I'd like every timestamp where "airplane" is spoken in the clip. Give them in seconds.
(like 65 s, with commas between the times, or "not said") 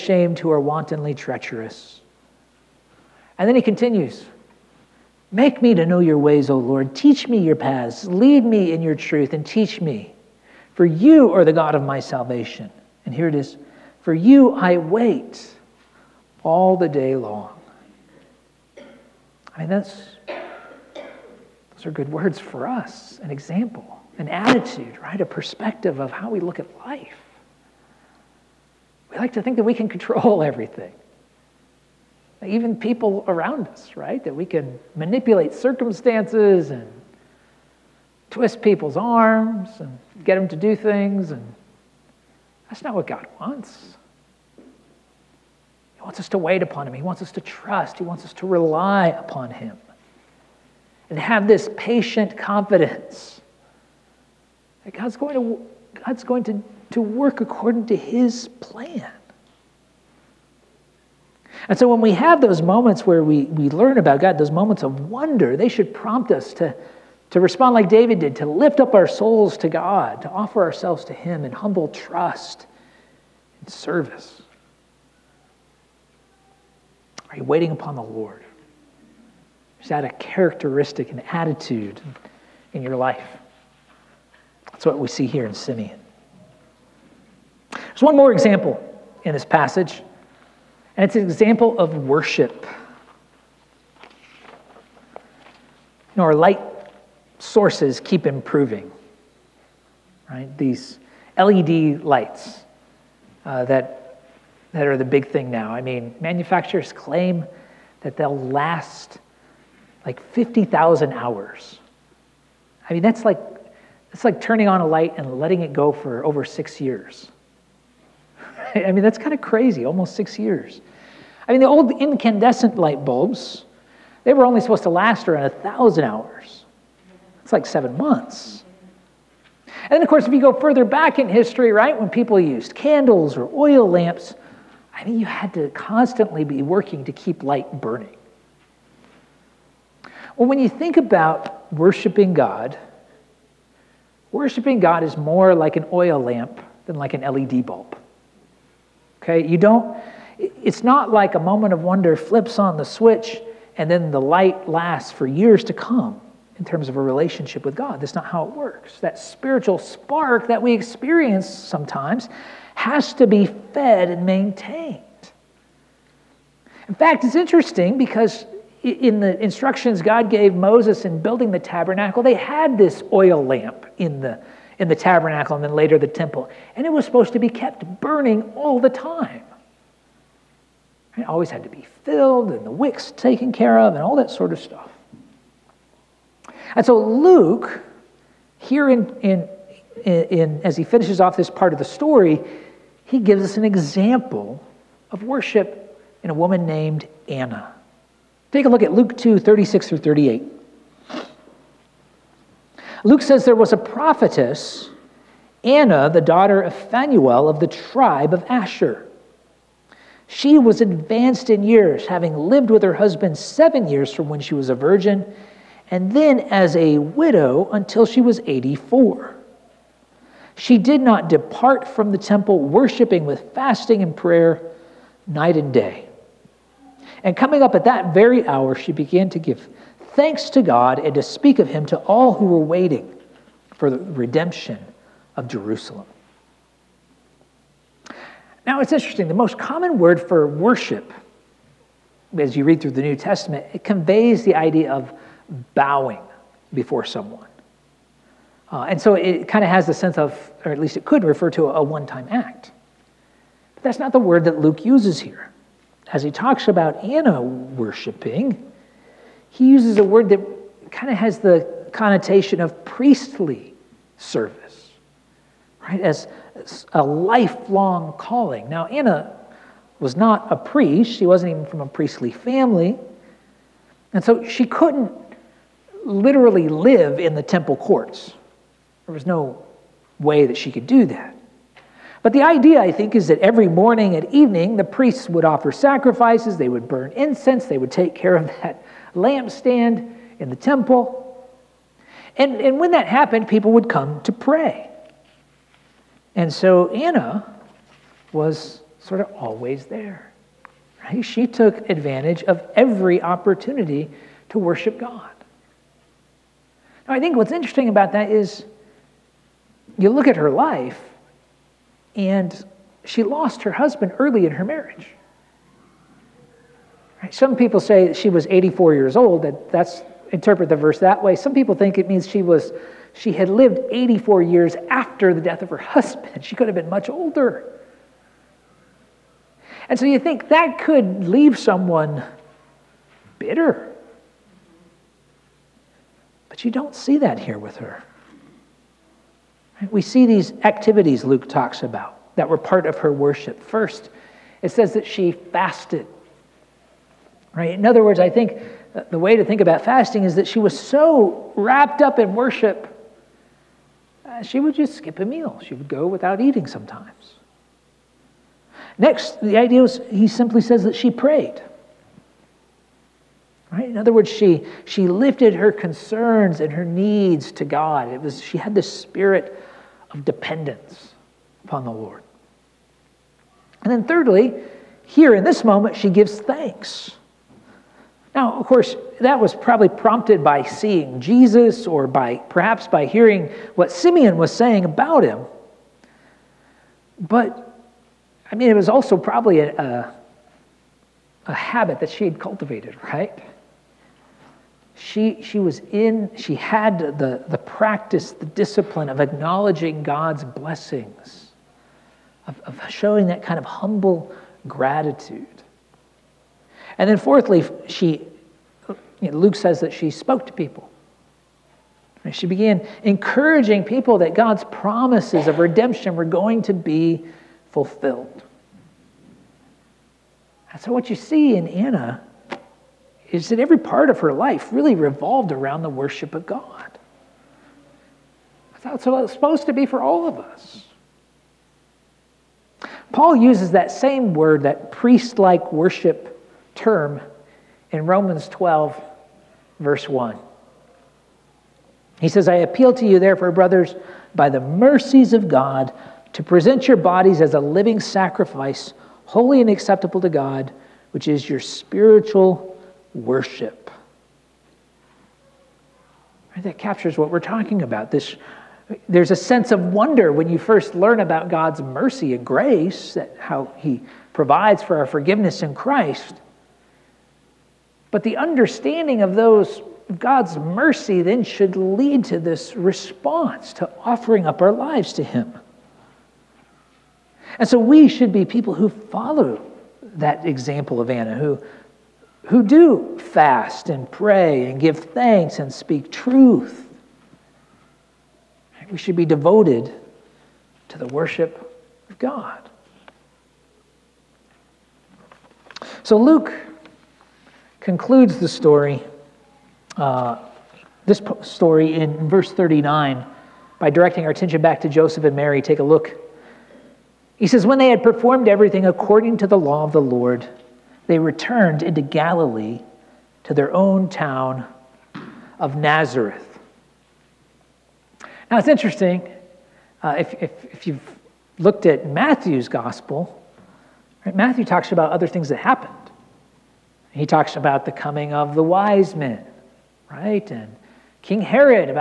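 not said.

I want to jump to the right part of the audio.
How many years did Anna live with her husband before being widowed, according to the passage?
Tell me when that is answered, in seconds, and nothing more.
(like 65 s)
213 s.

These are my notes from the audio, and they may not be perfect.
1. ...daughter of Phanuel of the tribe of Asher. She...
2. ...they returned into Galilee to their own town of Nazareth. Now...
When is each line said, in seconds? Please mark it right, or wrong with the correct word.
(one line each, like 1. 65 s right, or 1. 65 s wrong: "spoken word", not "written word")
1. 206 s right
2. 511 s right.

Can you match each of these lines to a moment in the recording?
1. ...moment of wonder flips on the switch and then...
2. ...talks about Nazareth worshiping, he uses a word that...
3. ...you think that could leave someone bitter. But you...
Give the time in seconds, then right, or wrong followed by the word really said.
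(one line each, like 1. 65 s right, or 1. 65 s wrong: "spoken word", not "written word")
1. 151 s right
2. 256 s wrong: "Anna", not "Nazareth"
3. 330 s right.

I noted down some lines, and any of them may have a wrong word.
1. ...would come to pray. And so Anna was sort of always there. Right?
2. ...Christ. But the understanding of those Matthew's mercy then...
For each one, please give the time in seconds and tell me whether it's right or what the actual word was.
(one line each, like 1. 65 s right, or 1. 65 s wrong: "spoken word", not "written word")
1. 293 s right
2. 465 s wrong: "God", not "Matthew".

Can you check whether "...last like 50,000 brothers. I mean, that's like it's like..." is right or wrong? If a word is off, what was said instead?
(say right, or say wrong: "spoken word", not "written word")
wrong: "hours", not "brothers".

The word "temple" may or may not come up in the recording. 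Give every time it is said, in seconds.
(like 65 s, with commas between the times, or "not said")
176 s, 222 s, 277 s, 290 s.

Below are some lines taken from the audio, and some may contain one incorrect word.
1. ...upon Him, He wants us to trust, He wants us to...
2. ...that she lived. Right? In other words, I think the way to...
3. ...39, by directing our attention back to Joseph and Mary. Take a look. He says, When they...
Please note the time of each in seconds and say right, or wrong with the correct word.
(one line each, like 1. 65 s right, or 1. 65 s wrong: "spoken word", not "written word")
1. 46 s right
2. 344 s wrong: "fasted", not "lived"
3. 502 s right.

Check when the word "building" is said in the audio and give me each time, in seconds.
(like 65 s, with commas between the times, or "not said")
171 s.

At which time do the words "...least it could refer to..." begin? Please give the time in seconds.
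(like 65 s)
250 s.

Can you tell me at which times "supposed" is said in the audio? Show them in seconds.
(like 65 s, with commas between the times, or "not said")
124 s, 177 s, 429 s.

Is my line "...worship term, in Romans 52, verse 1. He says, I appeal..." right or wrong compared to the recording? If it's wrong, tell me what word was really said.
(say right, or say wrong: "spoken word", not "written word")
wrong: "12", not "52".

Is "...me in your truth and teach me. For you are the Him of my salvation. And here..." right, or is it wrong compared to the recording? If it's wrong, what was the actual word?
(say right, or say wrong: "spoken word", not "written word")
wrong: "God", not "Him".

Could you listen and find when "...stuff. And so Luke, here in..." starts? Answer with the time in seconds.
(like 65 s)
184 s.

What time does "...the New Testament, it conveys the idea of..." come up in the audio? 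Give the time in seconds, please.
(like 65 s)
242 s.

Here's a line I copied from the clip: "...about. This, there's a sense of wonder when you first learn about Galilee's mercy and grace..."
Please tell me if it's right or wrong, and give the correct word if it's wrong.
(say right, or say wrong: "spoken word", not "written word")
wrong: "God", not "Galilee".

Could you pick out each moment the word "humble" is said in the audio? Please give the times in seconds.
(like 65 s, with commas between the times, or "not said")
71 s, 403 s.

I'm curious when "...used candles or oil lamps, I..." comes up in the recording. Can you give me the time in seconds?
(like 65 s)
132 s.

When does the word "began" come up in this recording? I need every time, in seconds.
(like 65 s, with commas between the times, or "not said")
228 s, 412 s.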